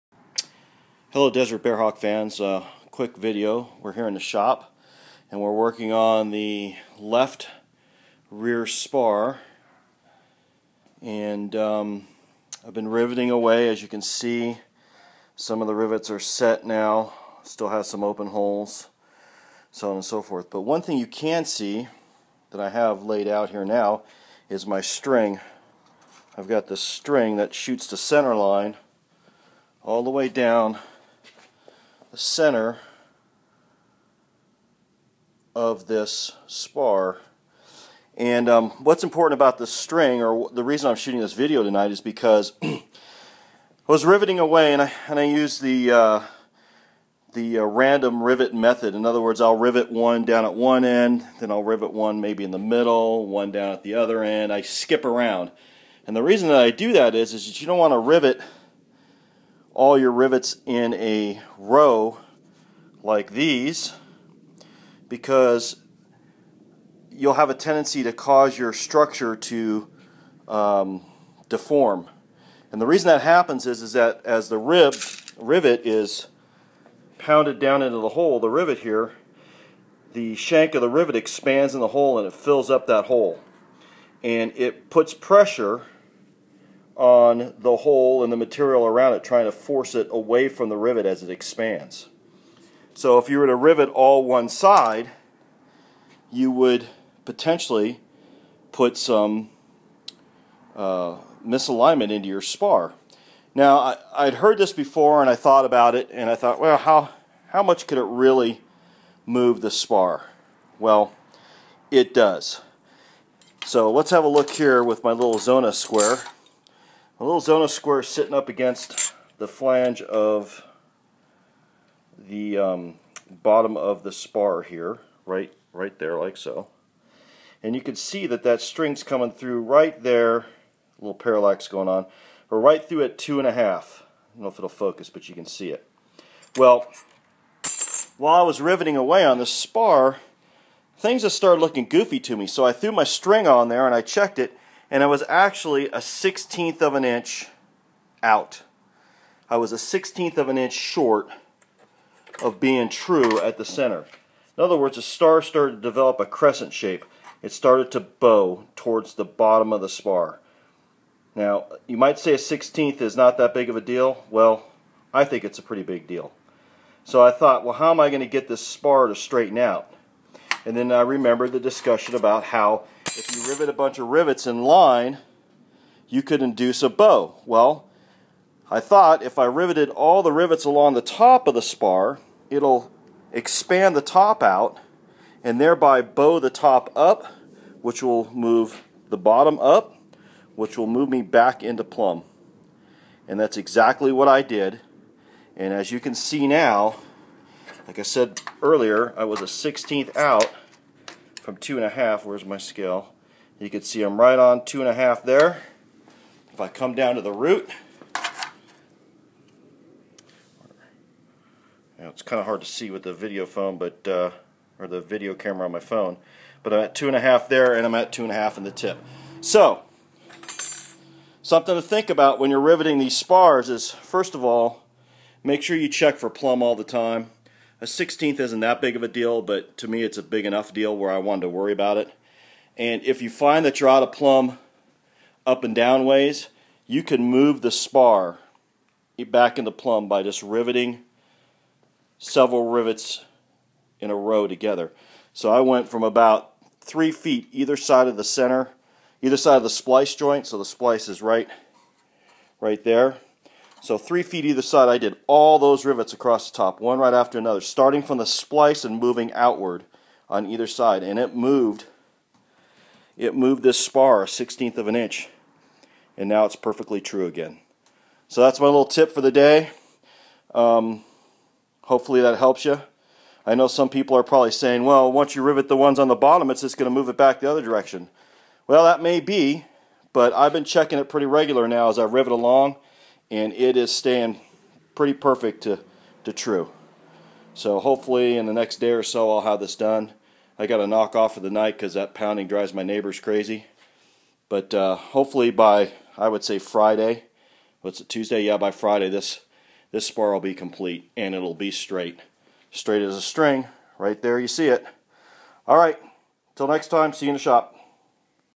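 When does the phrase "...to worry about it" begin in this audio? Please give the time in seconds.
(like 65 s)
231 s.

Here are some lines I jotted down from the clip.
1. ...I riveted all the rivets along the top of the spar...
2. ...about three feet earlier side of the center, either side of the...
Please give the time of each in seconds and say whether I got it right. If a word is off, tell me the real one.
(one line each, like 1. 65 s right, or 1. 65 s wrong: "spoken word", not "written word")
1. 179 s right
2. 246 s wrong: "either", not "earlier".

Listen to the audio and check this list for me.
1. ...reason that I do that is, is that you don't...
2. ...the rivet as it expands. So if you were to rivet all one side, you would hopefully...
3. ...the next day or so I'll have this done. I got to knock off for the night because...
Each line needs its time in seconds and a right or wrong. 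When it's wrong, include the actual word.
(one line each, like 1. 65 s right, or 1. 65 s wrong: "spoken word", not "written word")
1. 56 s right
2. 90 s wrong: "potentially", not "hopefully"
3. 288 s right.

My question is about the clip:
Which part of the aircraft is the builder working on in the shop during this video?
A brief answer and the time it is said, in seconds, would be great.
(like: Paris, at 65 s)
left rear spar, at 6 s.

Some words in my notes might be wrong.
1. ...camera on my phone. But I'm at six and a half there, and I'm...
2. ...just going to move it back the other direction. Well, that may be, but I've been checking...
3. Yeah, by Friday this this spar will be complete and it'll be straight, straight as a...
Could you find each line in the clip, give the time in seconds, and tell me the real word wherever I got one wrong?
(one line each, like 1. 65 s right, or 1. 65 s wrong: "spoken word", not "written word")
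1. 215 s wrong: "two", not "six"
2. 276 s right
3. 298 s right.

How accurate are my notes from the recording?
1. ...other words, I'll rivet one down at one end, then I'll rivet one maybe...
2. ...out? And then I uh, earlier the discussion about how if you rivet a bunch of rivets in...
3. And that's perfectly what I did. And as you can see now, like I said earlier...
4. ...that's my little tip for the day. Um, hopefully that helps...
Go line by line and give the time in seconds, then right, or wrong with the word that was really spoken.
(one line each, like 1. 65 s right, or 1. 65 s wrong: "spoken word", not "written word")
1. 49 s right
2. 169 s wrong: "remember", not "earlier"
3. 193 s wrong: "exactly", not "perfectly"
4. 268 s right.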